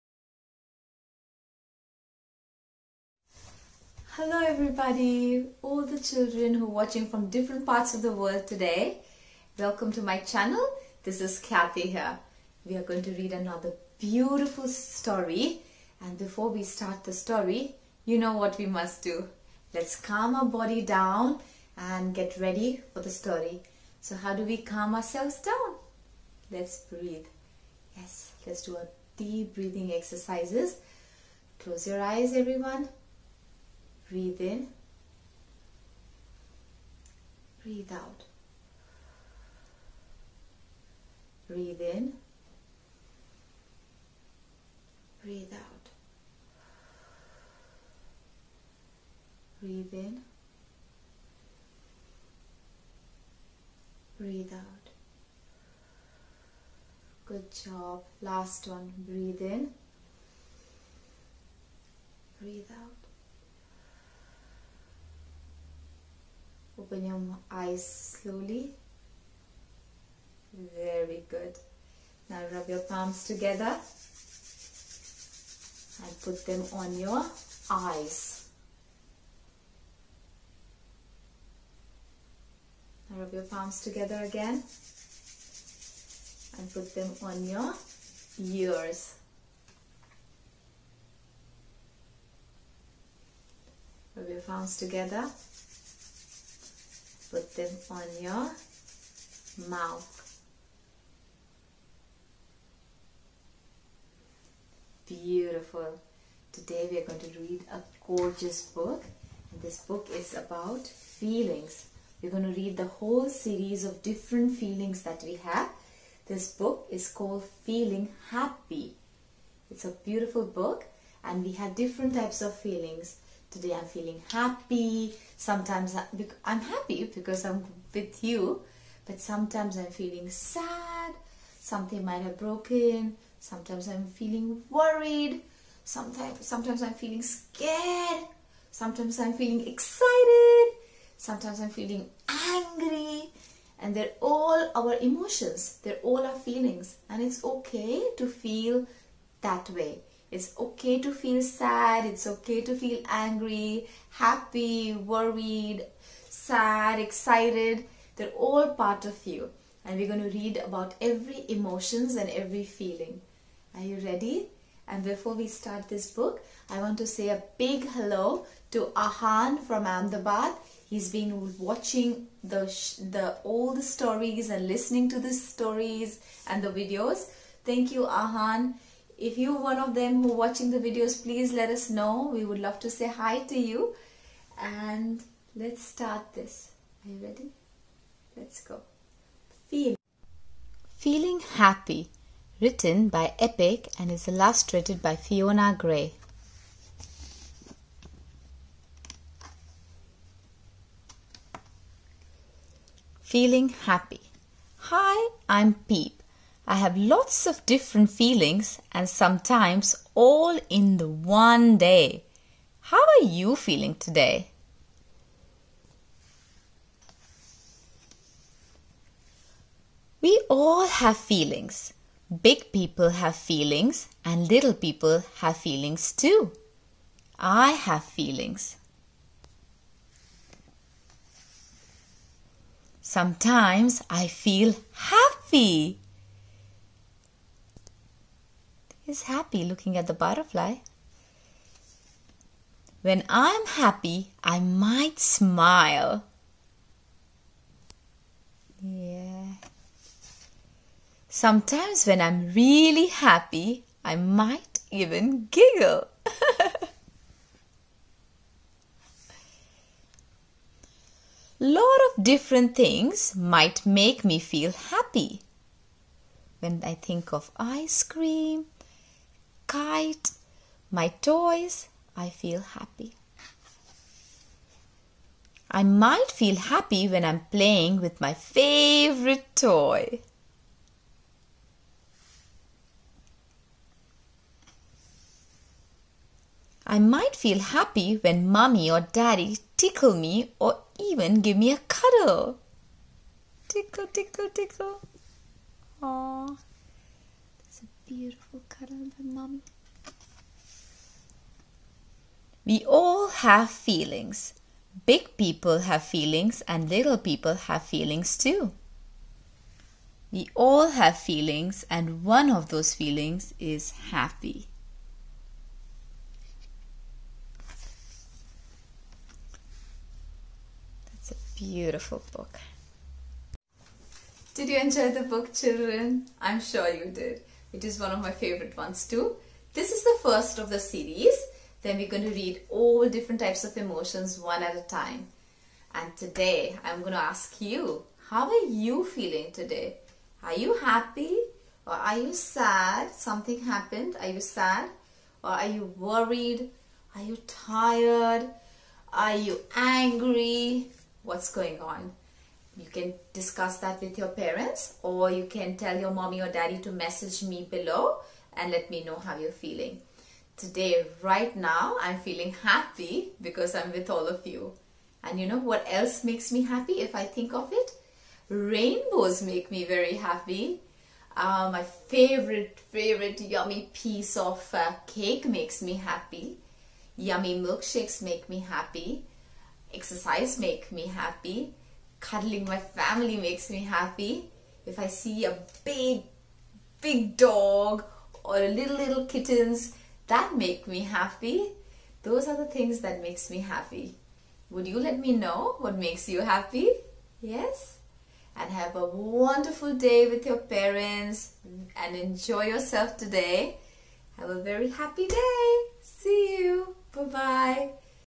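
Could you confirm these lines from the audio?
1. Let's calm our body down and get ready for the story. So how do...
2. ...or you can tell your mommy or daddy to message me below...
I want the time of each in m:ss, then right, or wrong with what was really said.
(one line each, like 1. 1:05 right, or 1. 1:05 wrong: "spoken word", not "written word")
1. 0:19 right
2. 5:55 right.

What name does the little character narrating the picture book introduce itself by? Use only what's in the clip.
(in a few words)
Peep.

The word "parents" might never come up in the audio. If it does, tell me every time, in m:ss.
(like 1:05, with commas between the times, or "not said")
5:54, 6:40.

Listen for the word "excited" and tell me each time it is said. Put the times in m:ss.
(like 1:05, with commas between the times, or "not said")
2:19, 2:36.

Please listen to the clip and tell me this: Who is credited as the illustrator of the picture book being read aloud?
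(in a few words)
Fiona Gray.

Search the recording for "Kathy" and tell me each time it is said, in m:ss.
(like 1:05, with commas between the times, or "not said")
0:11.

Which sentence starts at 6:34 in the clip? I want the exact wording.
Would you let me know what makes you happy?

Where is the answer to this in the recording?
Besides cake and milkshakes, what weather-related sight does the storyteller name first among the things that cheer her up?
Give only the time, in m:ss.
6:08.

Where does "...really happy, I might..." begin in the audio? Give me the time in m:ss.
4:12.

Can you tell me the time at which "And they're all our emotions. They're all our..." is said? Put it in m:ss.
2:23.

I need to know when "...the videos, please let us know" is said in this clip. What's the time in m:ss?
3:00.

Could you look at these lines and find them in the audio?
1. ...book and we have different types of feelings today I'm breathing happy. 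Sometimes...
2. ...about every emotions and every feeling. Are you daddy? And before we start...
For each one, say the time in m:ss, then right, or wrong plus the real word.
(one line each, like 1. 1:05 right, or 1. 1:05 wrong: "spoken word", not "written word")
1. 2:00 wrong: "feeling", not "breathing"
2. 2:40 wrong: "ready", not "daddy".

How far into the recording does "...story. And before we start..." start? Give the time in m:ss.
0:14.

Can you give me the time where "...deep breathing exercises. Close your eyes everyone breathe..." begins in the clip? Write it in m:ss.
0:29.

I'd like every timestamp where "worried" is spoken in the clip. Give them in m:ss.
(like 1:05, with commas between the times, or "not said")
2:14, 2:34, 5:45.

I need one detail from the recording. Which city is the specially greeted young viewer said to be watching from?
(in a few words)
Ahmedabad.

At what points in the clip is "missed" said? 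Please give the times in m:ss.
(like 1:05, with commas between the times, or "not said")
not said.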